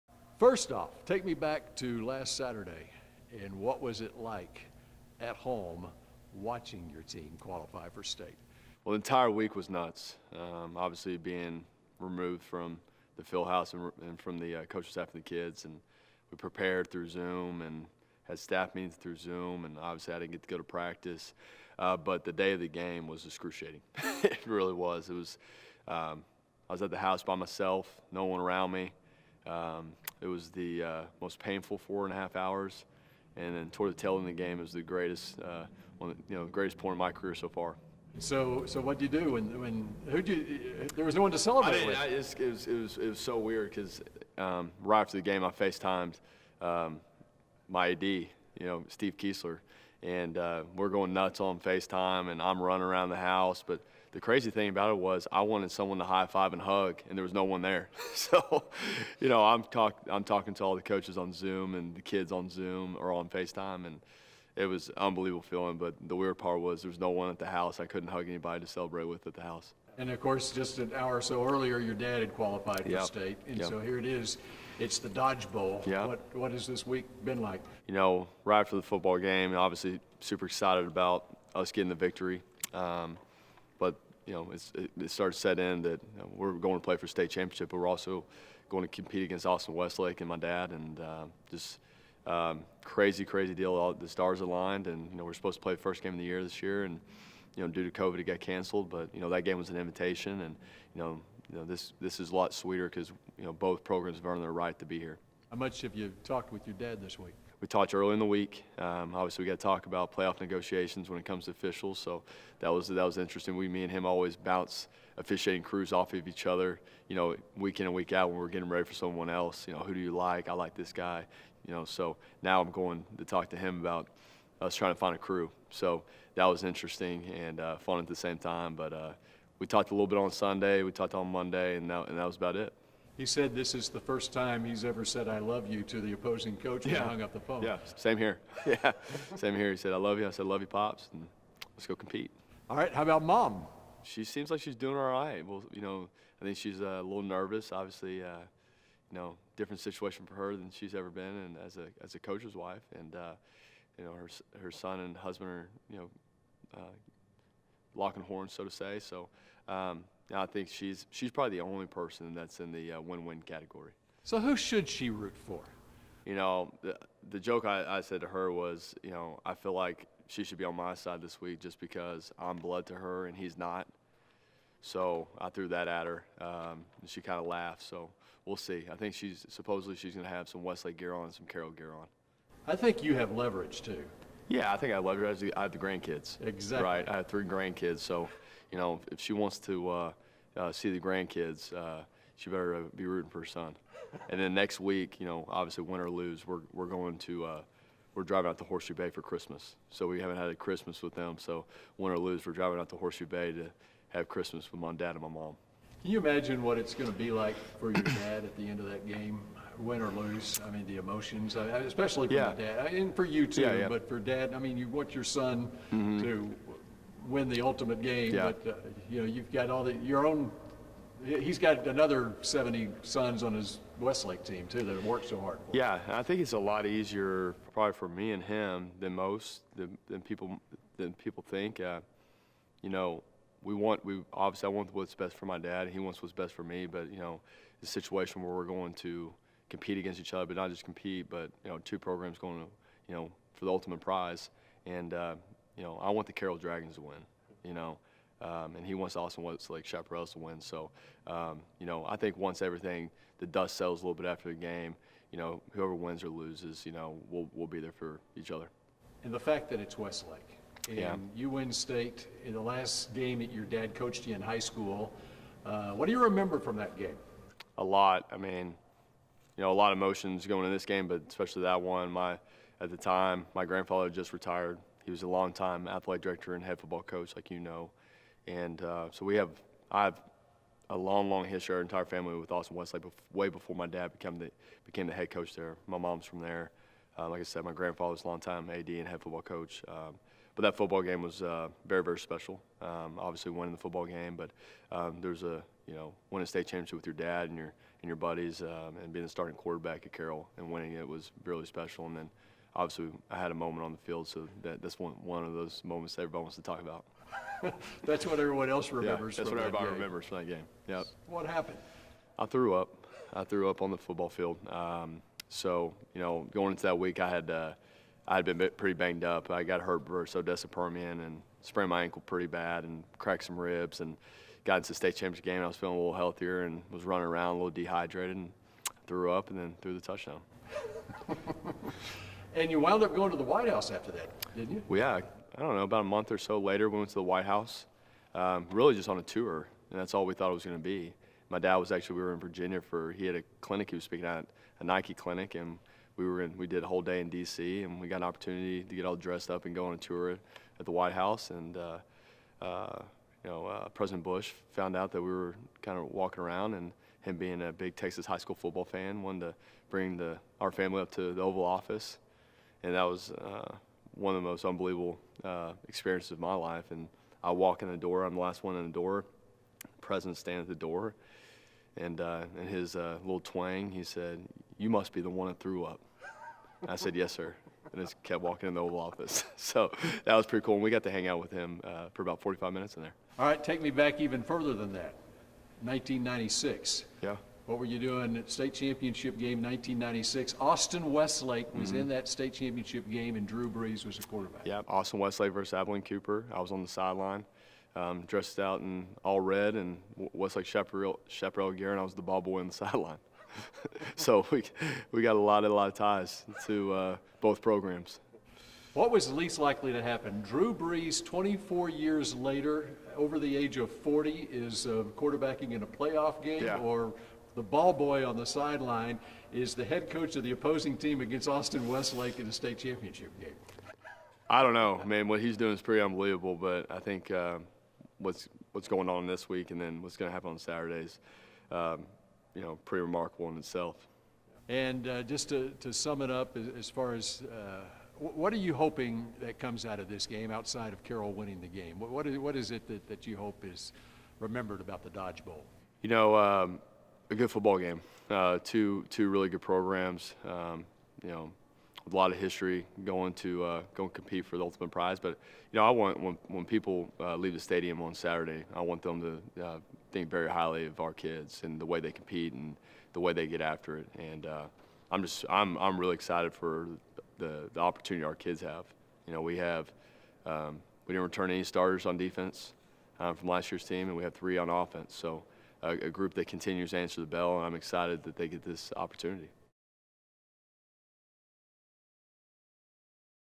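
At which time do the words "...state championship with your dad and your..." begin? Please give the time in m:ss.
4:56.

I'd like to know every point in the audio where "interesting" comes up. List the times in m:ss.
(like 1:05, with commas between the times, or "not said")
1:53, 2:06.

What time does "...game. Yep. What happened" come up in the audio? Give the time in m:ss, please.
5:10.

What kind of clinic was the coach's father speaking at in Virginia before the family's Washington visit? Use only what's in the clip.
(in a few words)
Nike clinic.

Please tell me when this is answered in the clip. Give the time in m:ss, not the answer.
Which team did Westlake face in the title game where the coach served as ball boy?
6:35.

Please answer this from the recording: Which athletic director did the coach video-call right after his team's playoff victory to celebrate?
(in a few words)
Steve Kiesler.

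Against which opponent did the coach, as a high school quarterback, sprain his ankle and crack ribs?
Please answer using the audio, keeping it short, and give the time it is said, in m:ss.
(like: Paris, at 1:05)
Odessa Permian, at 5:20.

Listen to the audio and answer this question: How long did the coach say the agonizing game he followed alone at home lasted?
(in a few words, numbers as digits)
4 and a half hours.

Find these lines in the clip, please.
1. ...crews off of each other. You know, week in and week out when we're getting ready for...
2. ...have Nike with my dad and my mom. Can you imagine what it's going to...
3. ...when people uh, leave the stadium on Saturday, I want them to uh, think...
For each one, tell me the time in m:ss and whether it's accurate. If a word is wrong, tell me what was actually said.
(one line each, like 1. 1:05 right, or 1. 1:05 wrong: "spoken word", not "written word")
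1. 1:55 right
2. 3:24 wrong: "Christmas", not "Nike"
3. 7:36 right.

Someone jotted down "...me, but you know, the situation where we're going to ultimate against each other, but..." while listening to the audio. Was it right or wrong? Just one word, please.
wrong.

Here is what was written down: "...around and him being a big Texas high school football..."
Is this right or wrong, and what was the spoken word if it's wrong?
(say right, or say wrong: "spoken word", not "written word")
right.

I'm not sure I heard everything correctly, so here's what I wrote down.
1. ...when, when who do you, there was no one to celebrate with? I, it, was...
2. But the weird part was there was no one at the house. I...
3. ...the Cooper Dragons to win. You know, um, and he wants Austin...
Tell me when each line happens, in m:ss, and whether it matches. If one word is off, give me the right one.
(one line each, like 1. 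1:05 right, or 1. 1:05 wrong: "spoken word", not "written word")
1. 0:39 right
2. 1:05 right
3. 4:06 wrong: "Carroll", not "Cooper".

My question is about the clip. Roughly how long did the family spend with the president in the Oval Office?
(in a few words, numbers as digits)
45 minutes.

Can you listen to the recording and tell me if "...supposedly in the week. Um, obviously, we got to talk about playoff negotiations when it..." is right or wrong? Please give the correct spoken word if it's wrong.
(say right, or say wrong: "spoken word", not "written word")
wrong: "early", not "supposedly".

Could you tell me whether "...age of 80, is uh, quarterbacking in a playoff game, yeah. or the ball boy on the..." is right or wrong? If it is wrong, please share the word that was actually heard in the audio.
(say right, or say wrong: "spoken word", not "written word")
wrong: "40", not "80".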